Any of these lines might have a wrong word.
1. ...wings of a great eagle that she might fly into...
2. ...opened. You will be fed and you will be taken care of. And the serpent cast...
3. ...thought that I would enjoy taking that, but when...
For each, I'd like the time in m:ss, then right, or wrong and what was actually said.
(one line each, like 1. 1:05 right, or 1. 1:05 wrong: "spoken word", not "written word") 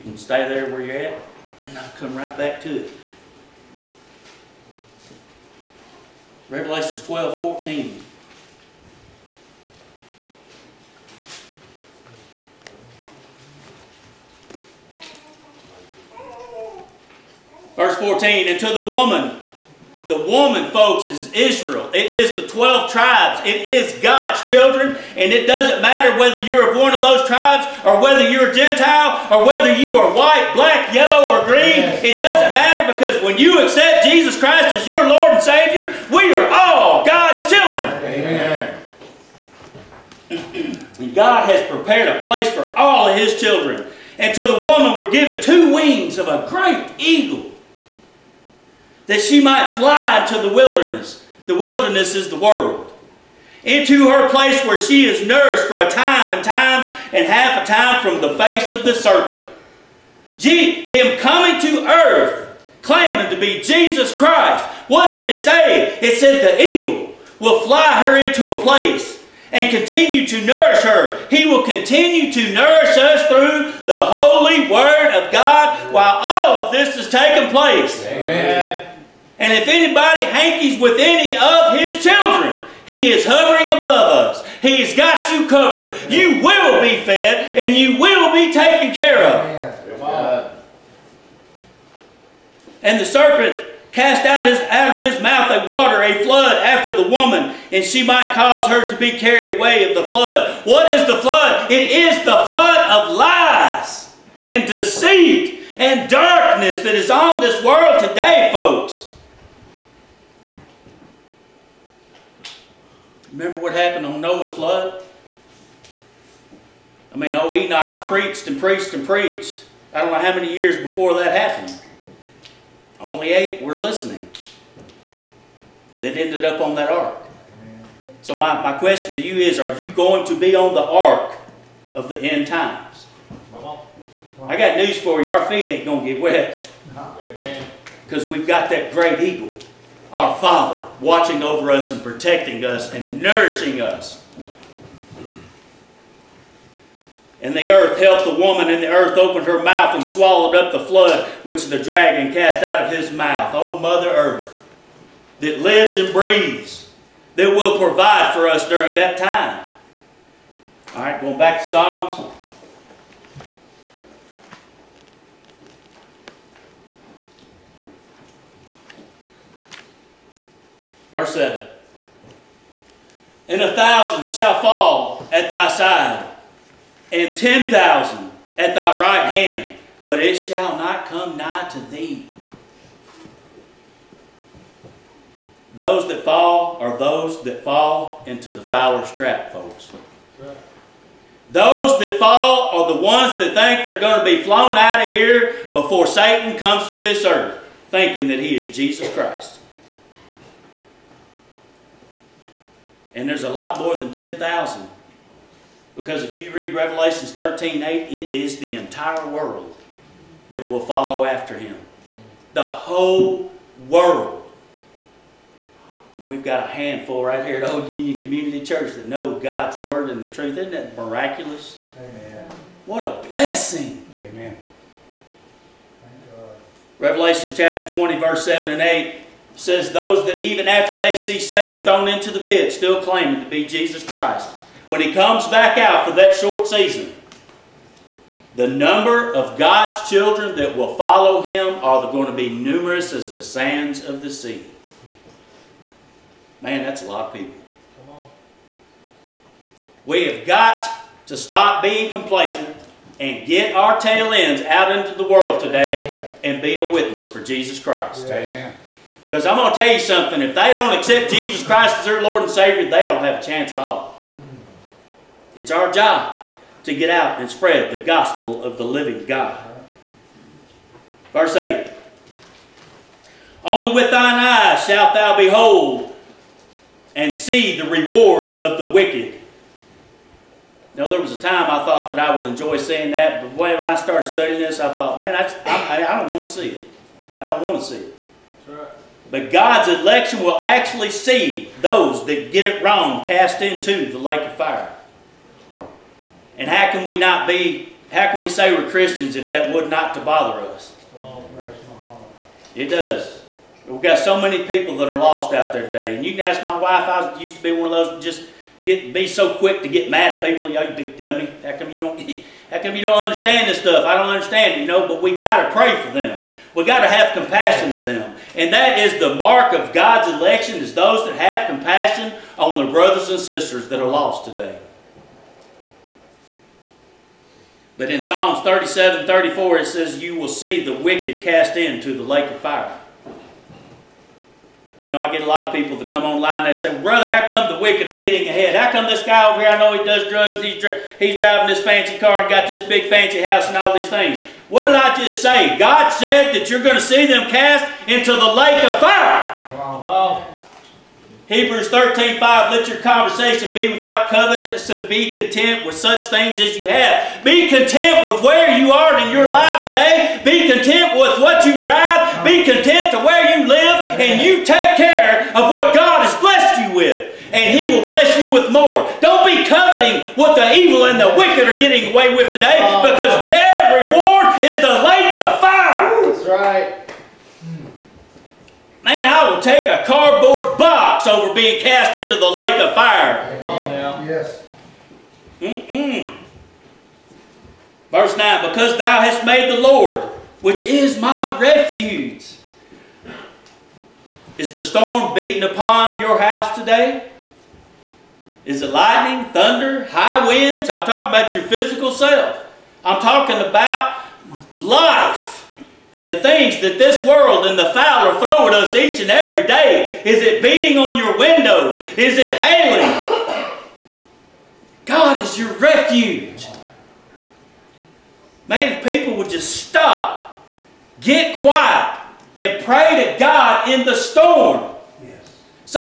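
1. 0:45 right
2. 1:25 wrong: "covered", not "opened"
3. 4:41 wrong: "seeing", not "taking".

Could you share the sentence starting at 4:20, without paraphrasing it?
If they don't accept Jesus Christ as their Lord and Savior, they don't have a chance at all.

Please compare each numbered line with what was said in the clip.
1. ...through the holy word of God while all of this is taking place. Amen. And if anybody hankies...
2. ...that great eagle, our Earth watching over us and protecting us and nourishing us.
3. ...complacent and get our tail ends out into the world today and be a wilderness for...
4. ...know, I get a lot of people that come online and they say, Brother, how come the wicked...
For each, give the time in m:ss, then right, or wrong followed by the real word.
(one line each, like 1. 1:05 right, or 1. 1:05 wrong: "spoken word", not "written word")
1. 1:13 right
2. 2:18 wrong: "Father", not "Earth"
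3. 4:12 wrong: "witness", not "wilderness"
4. 5:35 right.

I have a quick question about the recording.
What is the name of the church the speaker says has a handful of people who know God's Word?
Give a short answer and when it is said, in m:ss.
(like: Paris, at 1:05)
Old Union Community Church, at 3:37.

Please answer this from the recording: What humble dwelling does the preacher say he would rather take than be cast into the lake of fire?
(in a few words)
A cardboard box.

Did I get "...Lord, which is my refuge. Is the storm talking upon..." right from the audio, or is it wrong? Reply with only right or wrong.
wrong.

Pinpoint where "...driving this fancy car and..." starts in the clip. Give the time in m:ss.
5:41.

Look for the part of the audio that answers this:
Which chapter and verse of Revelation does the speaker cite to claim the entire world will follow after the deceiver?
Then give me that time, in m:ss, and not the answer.
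3:26.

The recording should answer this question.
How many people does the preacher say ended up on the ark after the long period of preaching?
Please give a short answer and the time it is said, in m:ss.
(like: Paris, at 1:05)
8, at 2:03.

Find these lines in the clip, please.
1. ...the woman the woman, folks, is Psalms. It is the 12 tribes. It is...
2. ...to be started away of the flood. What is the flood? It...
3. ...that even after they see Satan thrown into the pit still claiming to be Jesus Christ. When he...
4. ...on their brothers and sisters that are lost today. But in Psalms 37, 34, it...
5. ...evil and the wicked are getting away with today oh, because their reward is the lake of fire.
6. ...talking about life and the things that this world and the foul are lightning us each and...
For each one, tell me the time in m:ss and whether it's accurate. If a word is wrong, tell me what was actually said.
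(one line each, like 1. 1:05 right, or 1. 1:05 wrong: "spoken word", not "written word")
1. 0:18 wrong: "Israel", not "Psalms"
2. 1:38 wrong: "carried", not "started"
3. 3:50 right
4. 5:22 right
5. 6:10 right
6. 6:43 wrong: "throwing", not "lightning".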